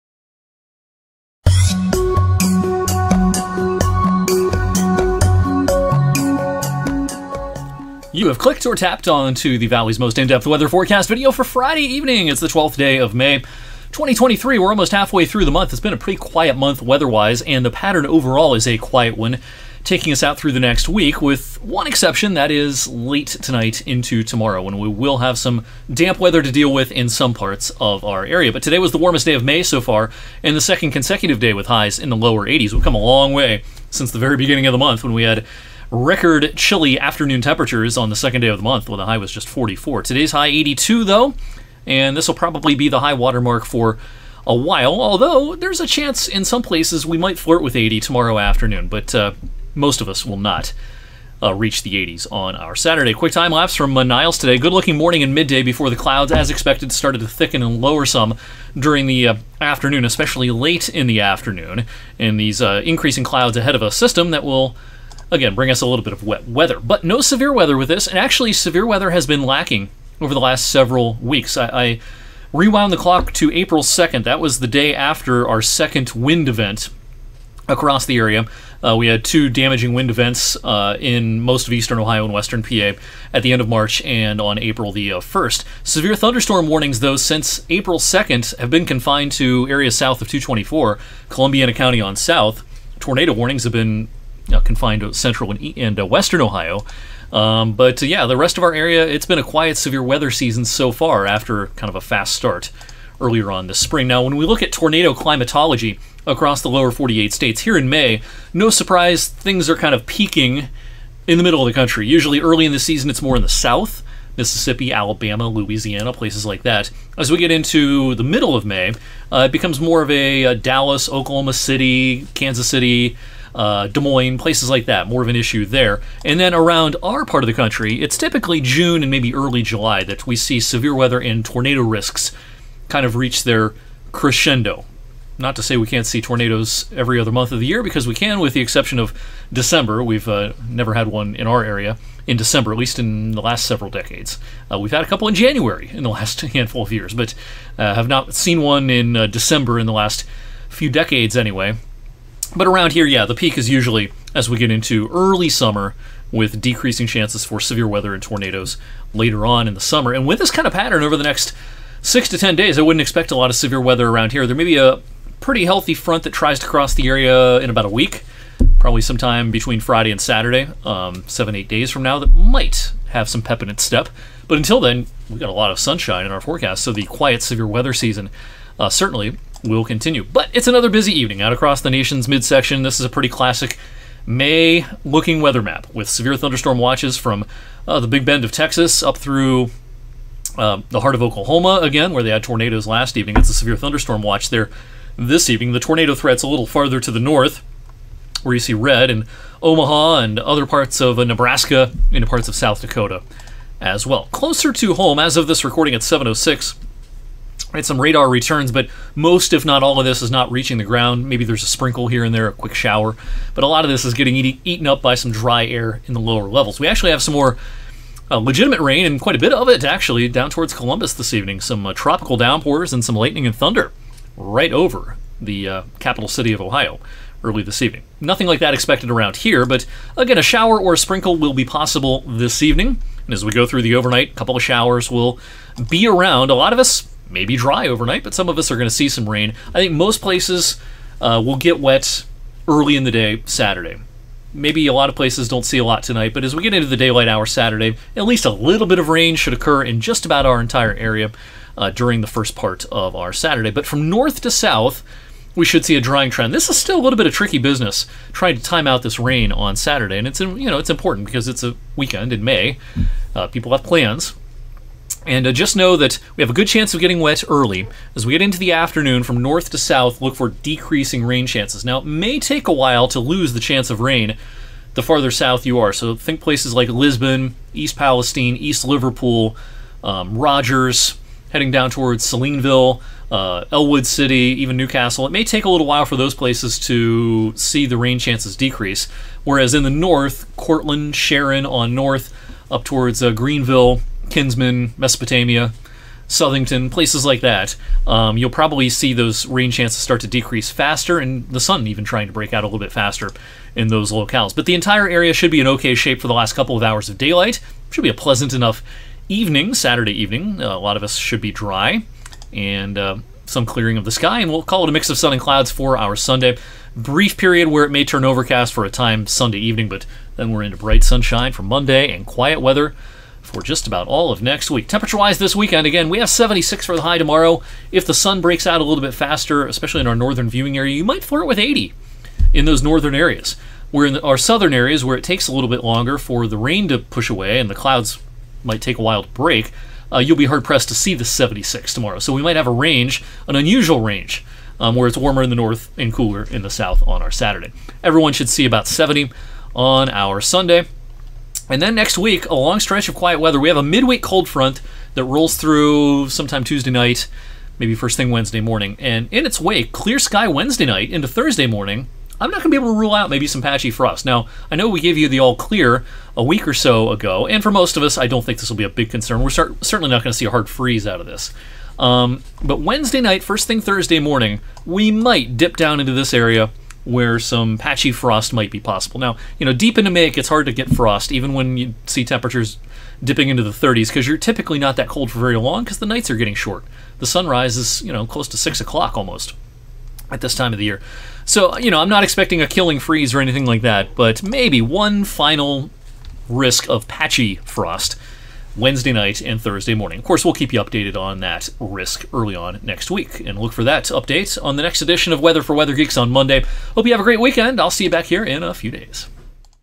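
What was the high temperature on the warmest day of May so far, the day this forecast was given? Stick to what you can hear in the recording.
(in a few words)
82.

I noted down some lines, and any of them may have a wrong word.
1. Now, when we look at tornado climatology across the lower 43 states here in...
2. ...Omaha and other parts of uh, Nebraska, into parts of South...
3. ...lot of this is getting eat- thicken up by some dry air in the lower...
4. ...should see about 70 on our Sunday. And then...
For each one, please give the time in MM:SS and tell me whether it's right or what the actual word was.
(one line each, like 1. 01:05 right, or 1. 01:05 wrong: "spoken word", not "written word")
1. 01:44 wrong: "48", not "43"
2. 03:19 right
3. 03:33 wrong: "eaten", not "thicken"
4. 05:48 right.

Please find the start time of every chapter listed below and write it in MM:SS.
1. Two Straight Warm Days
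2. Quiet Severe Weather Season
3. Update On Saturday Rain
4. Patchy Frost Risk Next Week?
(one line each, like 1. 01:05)
1. 00:45
2. 01:10
3. 03:00
4. 05:55.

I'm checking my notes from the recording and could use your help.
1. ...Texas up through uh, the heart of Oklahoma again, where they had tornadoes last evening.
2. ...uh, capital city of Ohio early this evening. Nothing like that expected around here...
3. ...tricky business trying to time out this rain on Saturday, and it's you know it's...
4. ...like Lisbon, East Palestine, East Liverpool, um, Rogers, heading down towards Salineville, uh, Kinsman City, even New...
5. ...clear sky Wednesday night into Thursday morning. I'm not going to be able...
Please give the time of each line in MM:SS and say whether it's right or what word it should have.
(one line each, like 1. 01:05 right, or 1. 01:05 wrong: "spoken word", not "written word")
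1. 03:08 right
2. 03:45 right
3. 04:17 right
4. 04:36 wrong: "Ellwood", not "Kinsman"
5. 05:59 right.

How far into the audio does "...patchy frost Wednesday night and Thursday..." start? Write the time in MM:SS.
06:37.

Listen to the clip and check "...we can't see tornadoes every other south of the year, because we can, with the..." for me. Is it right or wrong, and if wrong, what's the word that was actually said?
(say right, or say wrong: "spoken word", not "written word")
wrong: "month", not "south".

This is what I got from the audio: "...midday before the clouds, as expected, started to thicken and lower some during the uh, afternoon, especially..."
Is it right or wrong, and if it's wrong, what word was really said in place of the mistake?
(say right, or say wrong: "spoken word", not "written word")
right.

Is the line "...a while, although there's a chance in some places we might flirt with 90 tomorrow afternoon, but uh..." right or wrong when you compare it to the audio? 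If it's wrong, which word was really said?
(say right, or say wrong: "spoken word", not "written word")
wrong: "80", not "90".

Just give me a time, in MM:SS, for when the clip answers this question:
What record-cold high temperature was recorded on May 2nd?
00:39.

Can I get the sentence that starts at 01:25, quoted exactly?
Severe thunderstorm warnings, though, since April 2nd have been confined to areas south of 224, Columbiana County on south.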